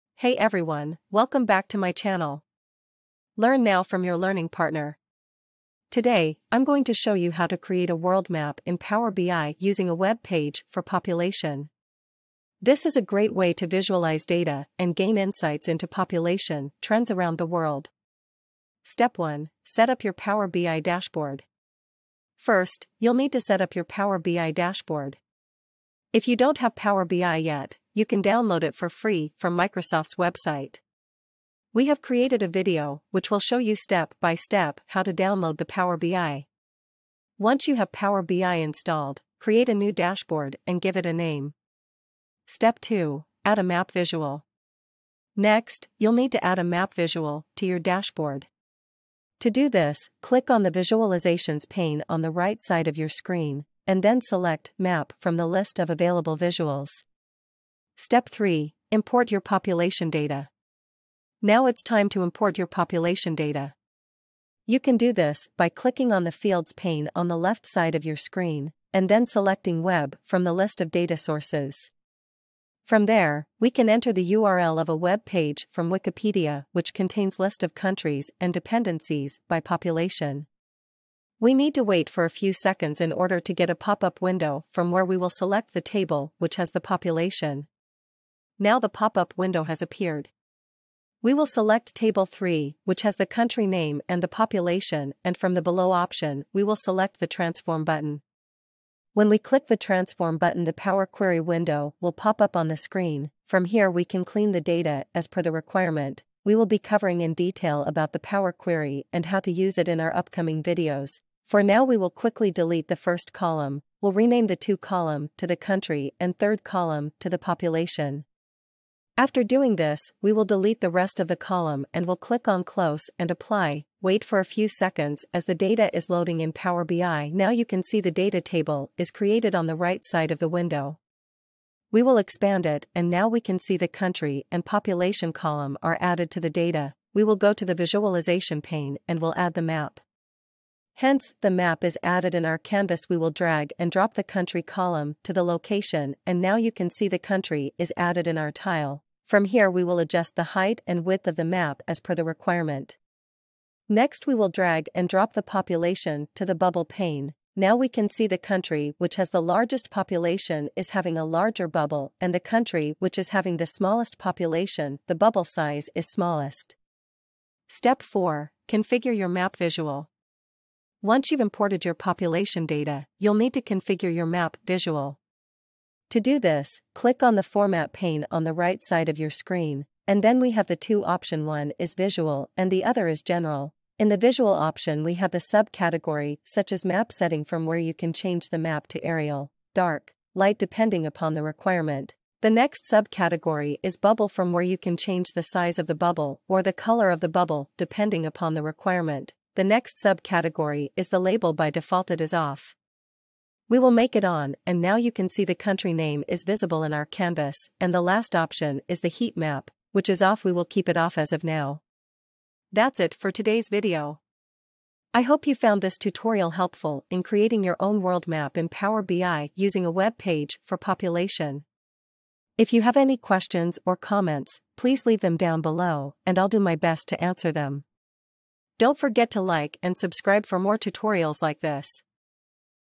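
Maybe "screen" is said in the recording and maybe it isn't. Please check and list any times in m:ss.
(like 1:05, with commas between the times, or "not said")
0:53, 1:08, 1:42, 2:59.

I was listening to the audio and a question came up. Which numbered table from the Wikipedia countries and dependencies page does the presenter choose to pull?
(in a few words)
Table 3.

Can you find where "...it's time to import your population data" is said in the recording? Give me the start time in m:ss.
1:01.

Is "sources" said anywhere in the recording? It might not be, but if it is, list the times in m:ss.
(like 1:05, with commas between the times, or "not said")
1:11.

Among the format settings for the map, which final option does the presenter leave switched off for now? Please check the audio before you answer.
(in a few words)
heat map.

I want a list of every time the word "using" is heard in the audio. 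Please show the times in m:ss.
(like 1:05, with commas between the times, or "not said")
0:09, 3:39.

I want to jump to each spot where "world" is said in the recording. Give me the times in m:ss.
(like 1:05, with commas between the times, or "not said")
0:07, 0:17, 3:38.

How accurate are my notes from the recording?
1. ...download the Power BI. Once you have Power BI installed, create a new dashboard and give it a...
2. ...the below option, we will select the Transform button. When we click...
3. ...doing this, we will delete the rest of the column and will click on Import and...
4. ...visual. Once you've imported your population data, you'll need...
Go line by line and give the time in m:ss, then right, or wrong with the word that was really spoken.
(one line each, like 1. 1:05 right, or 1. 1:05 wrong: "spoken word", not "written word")
1. 0:35 right
2. 1:35 right
3. 1:59 wrong: "Close", not "Import"
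4. 2:49 right.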